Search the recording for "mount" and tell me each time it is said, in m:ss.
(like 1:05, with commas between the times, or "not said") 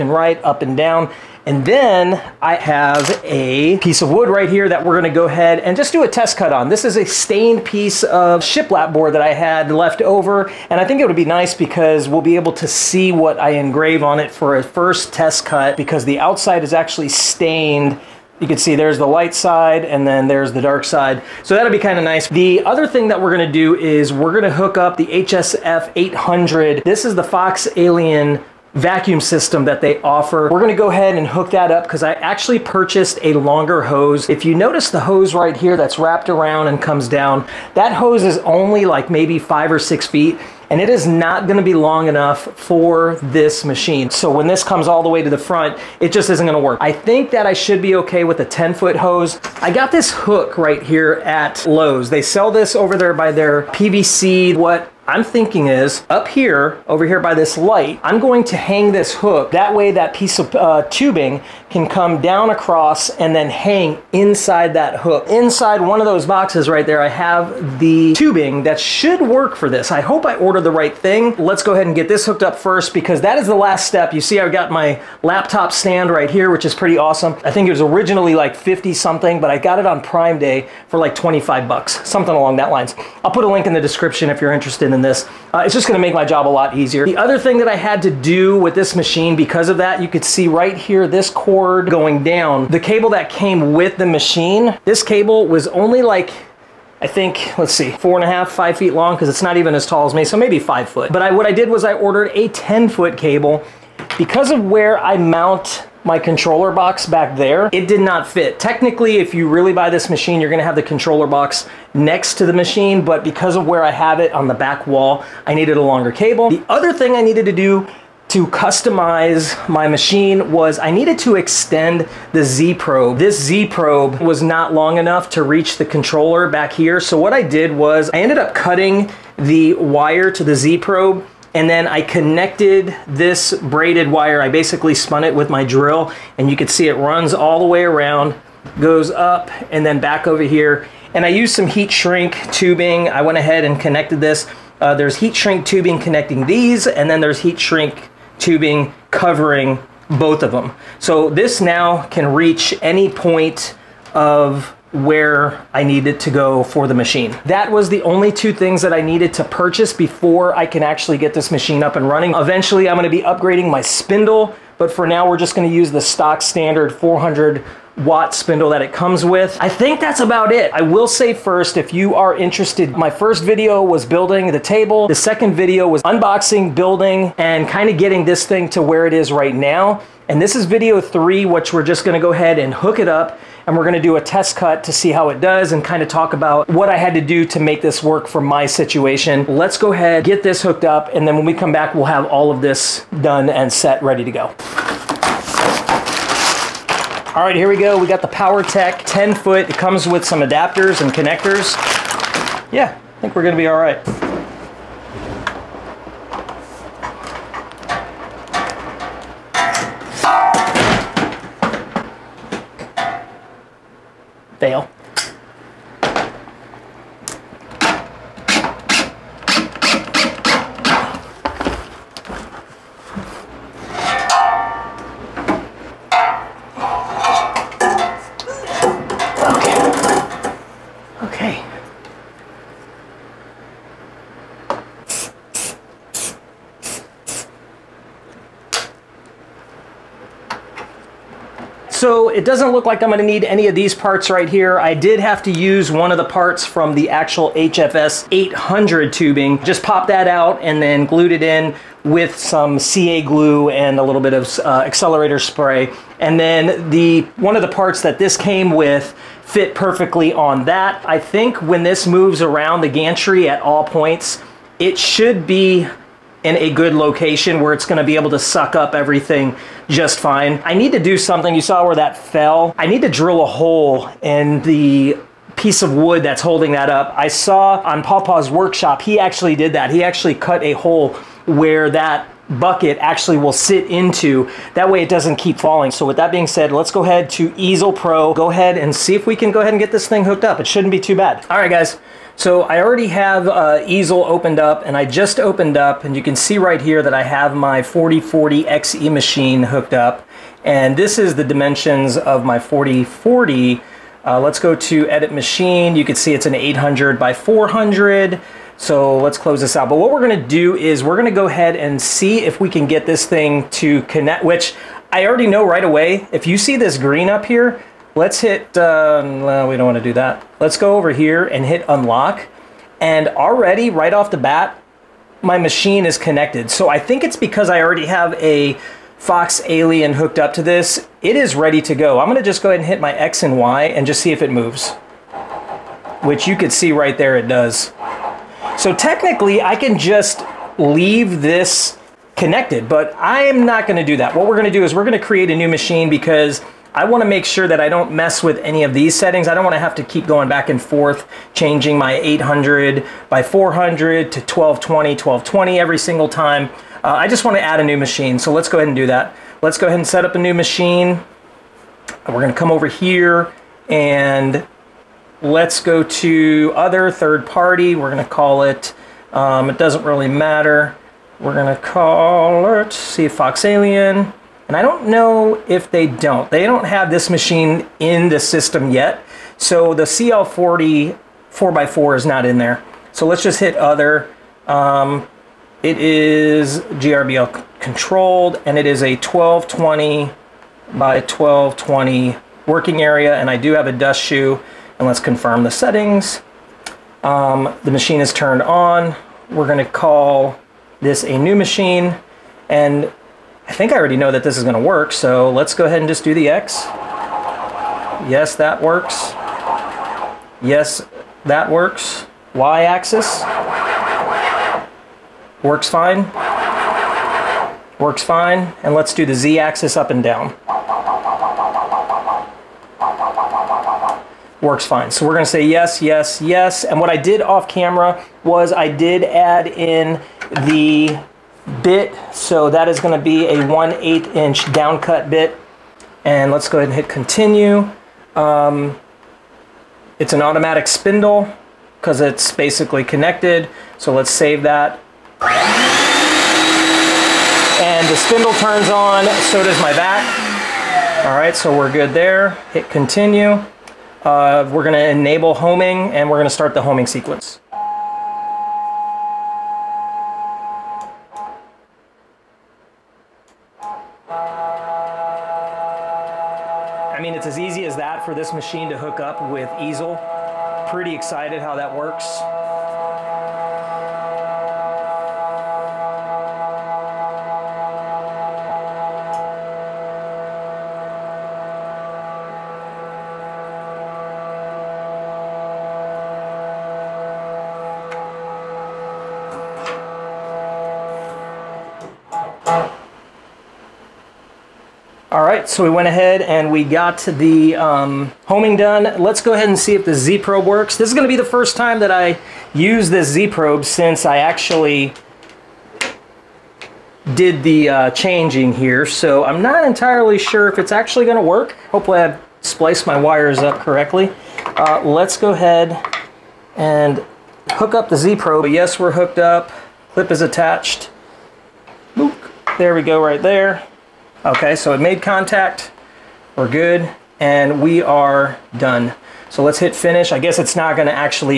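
1:45.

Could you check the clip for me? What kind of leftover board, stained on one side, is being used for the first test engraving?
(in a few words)
shiplap.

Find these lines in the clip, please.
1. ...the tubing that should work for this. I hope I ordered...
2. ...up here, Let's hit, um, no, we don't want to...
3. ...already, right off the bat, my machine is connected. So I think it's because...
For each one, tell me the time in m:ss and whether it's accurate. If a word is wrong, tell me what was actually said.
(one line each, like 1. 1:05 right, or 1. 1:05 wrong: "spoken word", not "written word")
1. 1:07 right
2. 5:17 right
3. 5:23 right.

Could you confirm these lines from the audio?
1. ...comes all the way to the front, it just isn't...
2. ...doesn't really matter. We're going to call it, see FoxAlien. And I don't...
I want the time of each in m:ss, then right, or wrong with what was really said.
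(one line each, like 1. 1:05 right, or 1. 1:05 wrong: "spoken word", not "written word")
1. 0:44 right
2. 6:09 right.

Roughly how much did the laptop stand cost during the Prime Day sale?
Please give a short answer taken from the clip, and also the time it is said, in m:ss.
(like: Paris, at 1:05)
$25, at 1:21.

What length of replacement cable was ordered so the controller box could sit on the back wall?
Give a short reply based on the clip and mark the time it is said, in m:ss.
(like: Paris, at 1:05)
10 foot, at 1:42.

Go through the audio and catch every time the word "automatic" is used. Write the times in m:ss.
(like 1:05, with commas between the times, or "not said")
7:20.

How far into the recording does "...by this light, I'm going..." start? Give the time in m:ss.
0:57.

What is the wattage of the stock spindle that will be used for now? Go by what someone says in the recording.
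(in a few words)
400 watt.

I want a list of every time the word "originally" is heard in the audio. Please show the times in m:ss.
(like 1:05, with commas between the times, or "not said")
1:17.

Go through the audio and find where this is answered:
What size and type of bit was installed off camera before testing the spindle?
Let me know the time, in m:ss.
7:13.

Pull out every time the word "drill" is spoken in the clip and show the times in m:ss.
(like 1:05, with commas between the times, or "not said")
2:15, 4:33.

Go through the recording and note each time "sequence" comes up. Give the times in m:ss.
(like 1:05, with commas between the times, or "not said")
7:37.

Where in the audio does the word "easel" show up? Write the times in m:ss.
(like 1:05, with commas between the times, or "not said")
4:47, 4:53, 7:49.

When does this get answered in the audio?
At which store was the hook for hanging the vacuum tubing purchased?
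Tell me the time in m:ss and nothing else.
0:51.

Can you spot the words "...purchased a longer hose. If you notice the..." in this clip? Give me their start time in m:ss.
0:32.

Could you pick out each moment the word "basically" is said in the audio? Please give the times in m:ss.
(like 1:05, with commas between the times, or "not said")
2:14, 7:22.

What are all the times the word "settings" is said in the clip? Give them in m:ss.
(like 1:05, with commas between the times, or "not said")
5:49, 6:35.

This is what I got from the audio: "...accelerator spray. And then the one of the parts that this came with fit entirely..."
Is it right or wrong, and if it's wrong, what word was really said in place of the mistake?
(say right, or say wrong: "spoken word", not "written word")
wrong: "perfectly", not "entirely".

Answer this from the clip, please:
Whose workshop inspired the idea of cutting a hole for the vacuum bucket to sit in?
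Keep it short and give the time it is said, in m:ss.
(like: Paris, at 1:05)
Pawpaw's, at 4:38.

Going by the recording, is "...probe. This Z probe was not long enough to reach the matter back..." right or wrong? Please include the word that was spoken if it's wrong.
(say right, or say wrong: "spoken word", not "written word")
wrong: "controller", not "matter".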